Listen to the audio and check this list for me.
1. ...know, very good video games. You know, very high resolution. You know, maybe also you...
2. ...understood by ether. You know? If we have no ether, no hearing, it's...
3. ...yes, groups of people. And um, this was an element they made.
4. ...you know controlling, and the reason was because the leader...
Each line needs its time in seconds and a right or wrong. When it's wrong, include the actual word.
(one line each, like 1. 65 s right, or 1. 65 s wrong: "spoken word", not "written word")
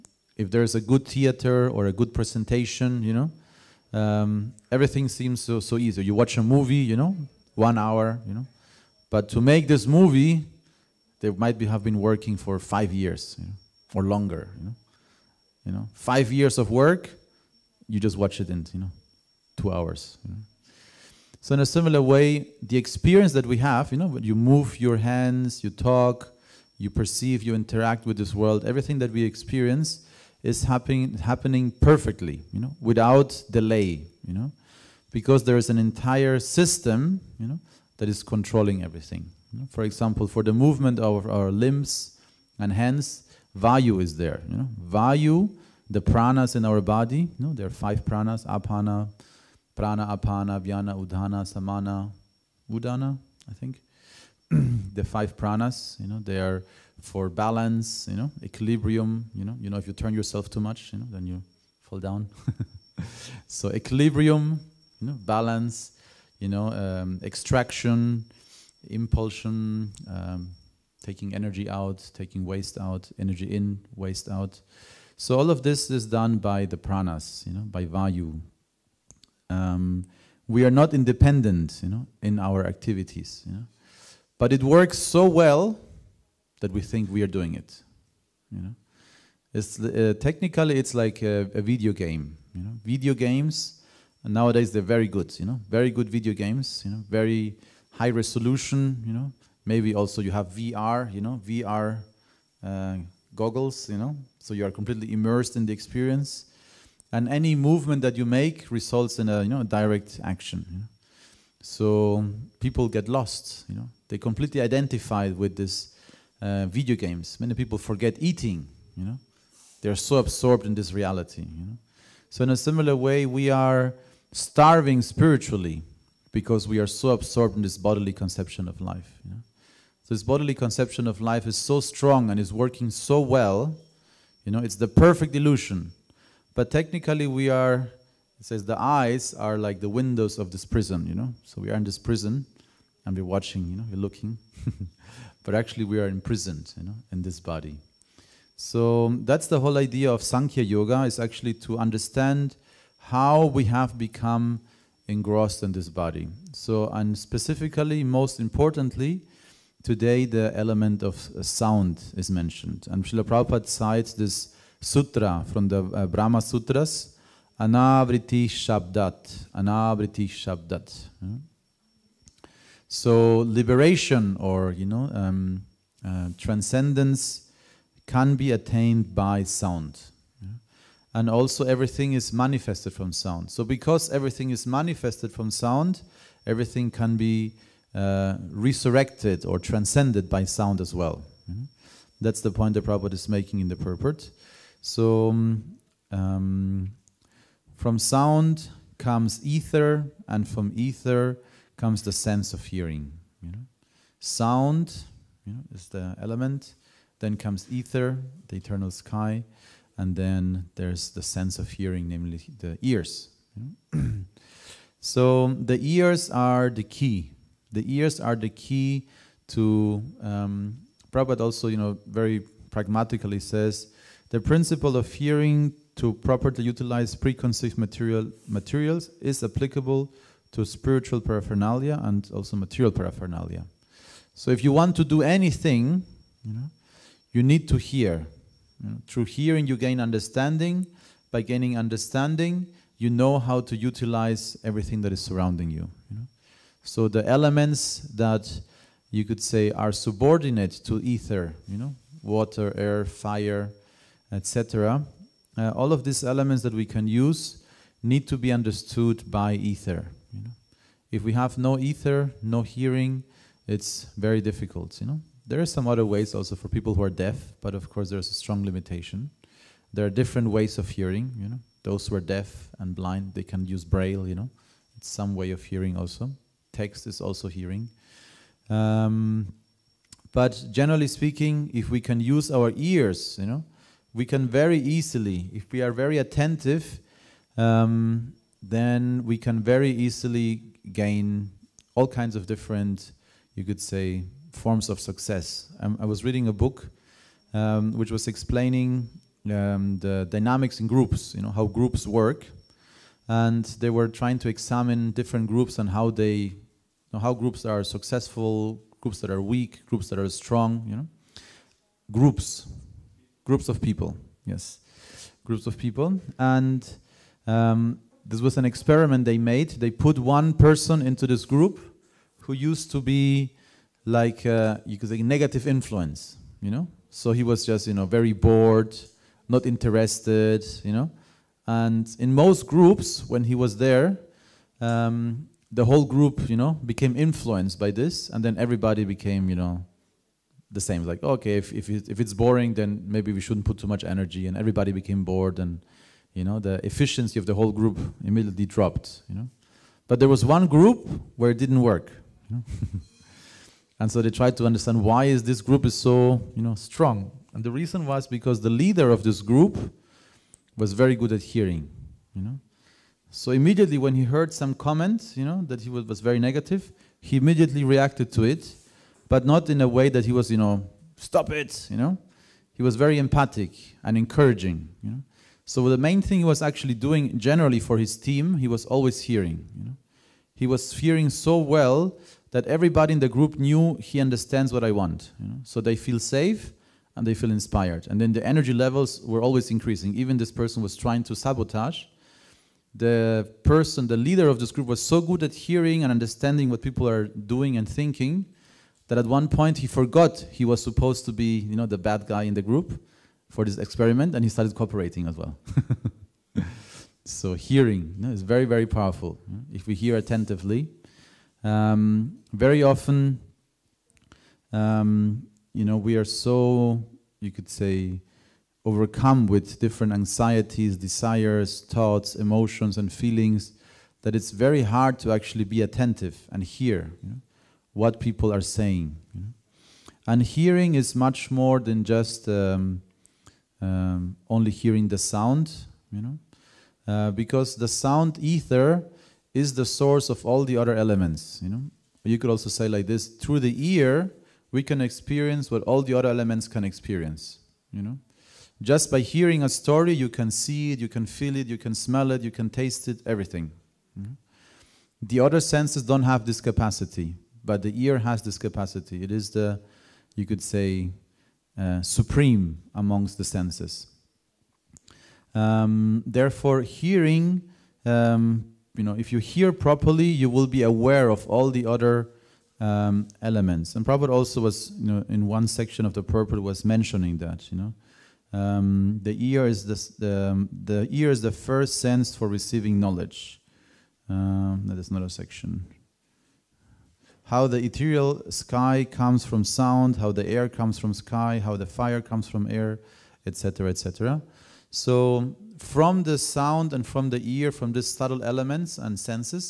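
1. 95 s right
2. 258 s right
3. 314 s wrong: "experiment", not "element"
4. 356 s wrong: "strong", not "controlling".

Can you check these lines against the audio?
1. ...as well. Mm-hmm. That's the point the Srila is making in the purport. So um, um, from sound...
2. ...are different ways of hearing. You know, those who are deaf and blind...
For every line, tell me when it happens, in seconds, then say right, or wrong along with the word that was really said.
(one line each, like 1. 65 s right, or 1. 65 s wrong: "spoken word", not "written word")
1. 190 s wrong: "Prabhupada", not "Srila"
2. 270 s right.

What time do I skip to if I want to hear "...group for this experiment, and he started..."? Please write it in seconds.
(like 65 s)
402 s.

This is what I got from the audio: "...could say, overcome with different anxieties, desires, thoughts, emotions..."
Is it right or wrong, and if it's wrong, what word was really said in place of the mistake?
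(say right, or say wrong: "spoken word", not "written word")
right.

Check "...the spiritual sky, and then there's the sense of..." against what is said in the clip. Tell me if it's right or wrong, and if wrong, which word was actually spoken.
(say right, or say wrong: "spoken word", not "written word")
wrong: "eternal", not "spiritual".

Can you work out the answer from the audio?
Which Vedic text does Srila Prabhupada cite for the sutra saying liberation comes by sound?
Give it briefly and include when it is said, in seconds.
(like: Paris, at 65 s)
Brahma Sutras, at 166 s.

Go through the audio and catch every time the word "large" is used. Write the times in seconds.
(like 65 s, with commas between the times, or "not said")
not said.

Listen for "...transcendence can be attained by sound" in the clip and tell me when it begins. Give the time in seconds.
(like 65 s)
176 s.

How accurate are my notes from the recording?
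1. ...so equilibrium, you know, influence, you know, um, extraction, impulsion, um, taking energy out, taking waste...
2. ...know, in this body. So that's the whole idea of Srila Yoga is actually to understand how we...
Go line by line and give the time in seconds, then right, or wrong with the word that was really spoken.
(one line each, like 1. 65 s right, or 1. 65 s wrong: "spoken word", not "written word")
1. 63 s wrong: "balance", not "influence"
2. 146 s wrong: "Sankhya", not "Srila".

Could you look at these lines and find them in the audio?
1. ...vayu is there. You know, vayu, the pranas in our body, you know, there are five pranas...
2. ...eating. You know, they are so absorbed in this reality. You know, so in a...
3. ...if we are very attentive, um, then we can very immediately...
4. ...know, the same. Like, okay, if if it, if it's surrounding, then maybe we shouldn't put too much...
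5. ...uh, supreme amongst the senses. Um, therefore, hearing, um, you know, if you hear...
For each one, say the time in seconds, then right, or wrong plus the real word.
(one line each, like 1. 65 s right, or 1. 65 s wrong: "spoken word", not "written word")
1. 43 s right
2. 118 s right
3. 285 s wrong: "easily", not "immediately"
4. 339 s wrong: "boring", not "surrounding"
5. 461 s right.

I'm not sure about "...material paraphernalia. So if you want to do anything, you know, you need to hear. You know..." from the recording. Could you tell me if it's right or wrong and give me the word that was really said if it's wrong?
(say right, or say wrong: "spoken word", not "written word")
right.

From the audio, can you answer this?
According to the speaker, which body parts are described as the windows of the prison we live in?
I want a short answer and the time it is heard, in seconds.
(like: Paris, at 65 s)
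the eyes, at 138 s.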